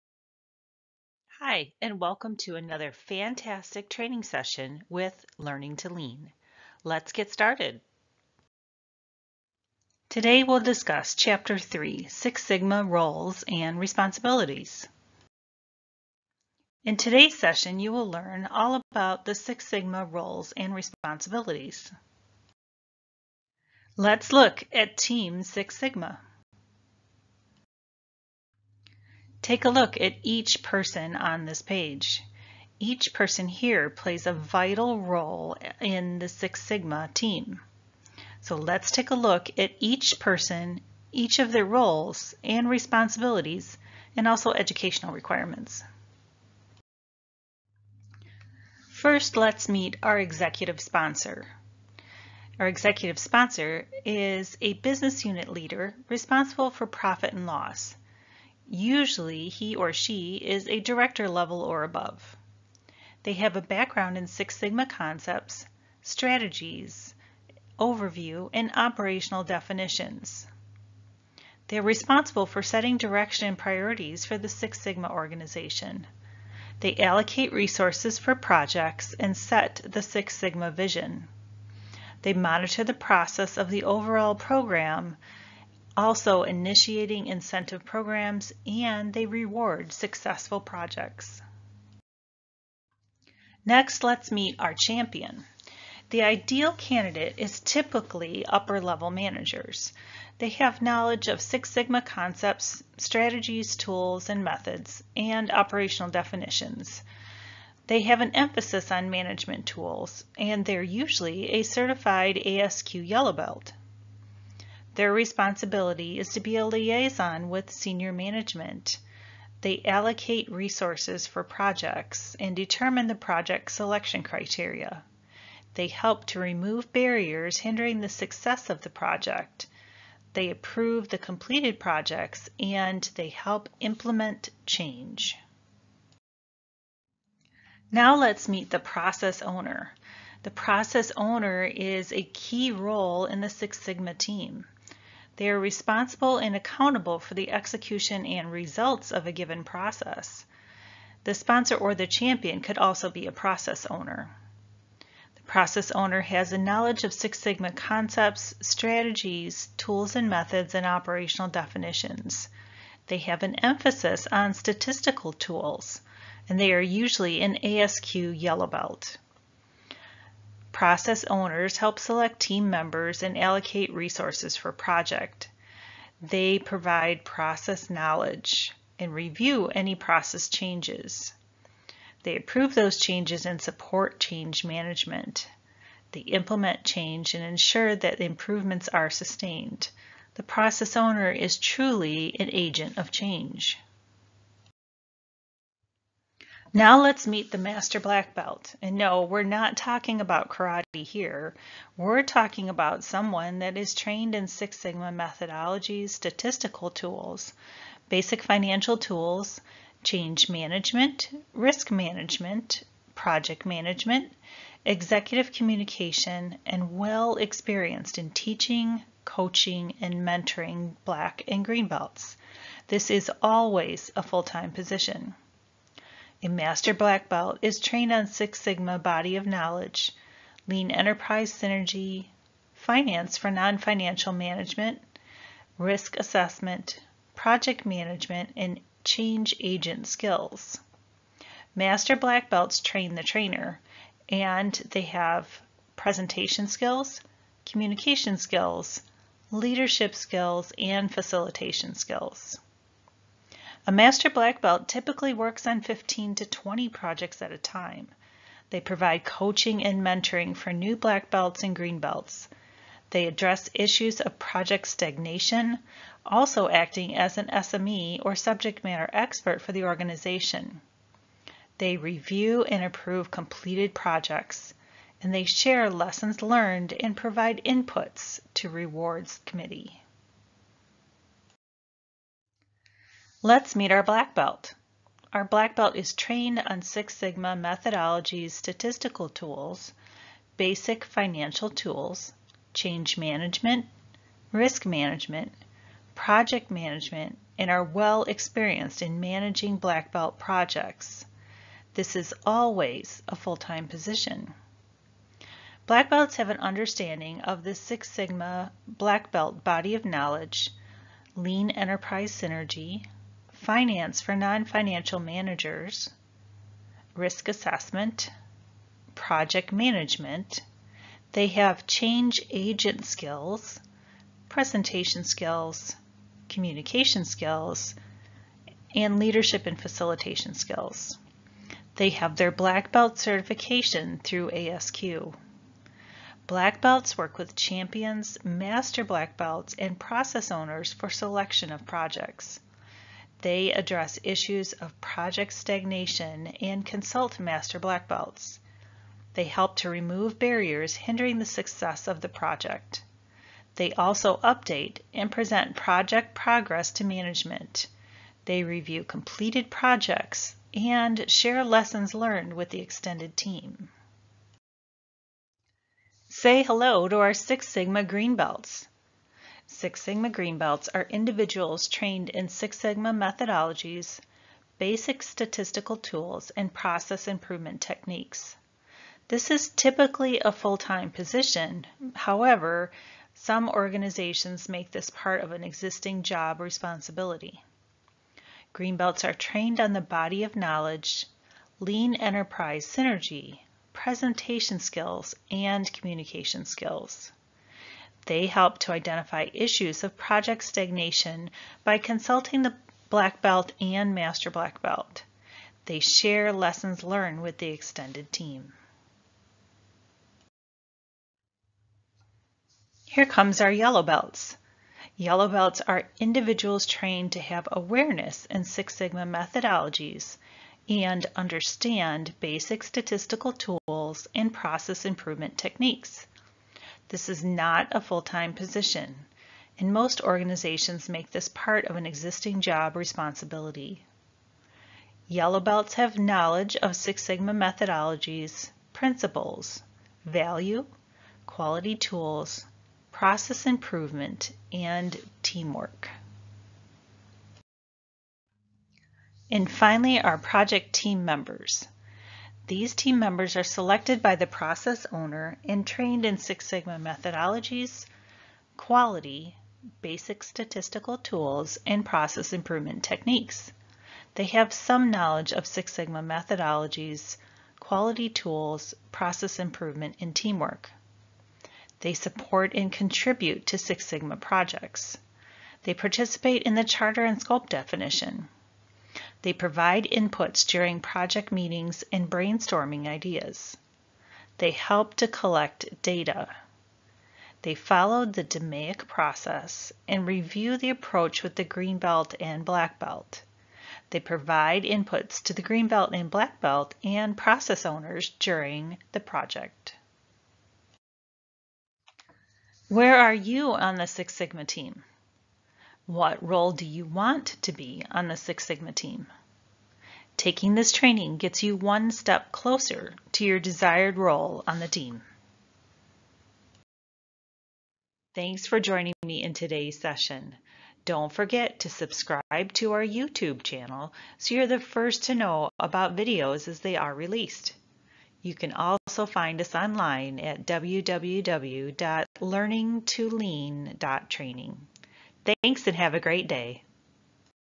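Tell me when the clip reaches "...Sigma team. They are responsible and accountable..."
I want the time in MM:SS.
02:23.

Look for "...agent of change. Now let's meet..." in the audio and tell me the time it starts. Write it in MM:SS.
03:12.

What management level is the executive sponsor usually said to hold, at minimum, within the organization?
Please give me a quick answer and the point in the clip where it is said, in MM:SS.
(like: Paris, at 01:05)
Director level, at 01:00.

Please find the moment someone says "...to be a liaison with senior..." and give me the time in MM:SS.
01:56.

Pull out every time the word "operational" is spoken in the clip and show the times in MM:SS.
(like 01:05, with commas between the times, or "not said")
01:08, 01:45, 02:40.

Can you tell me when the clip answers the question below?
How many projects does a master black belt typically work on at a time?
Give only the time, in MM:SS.
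04:15.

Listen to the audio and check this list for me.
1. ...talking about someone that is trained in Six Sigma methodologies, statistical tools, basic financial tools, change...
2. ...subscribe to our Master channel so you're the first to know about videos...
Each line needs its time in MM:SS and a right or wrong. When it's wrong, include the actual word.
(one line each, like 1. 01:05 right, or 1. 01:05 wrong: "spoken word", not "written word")
1. 03:22 right
2. 08:41 wrong: "YouTube", not "Master".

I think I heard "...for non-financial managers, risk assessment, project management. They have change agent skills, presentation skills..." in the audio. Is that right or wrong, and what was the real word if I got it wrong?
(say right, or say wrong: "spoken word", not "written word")
right.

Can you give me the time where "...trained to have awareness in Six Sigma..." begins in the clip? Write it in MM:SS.
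06:56.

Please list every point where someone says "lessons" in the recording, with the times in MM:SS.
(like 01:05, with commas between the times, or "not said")
04:35, 06:01, 06:46.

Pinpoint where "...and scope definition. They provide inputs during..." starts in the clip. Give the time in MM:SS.
07:57.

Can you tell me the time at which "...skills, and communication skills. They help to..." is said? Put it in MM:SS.
06:34.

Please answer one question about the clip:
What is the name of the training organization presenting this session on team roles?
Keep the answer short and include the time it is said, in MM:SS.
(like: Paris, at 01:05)
Learning to Lean, at 00:05.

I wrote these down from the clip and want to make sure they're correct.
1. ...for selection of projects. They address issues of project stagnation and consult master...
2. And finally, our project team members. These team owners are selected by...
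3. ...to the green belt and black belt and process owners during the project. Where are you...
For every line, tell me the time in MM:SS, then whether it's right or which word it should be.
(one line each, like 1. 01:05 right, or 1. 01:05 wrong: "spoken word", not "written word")
1. 05:40 right
2. 07:29 wrong: "members", not "owners"
3. 08:15 right.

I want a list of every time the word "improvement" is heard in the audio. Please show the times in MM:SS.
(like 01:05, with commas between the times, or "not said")
03:08, 06:17, 07:05, 07:23, 07:42, 07:49.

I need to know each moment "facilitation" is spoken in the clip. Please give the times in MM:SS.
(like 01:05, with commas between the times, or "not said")
04:11, 05:29.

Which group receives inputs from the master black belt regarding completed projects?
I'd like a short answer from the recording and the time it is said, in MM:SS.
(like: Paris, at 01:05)
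Rewards committee, at 04:38.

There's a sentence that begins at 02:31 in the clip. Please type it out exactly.
The sponsor or the champion could also be a process owner.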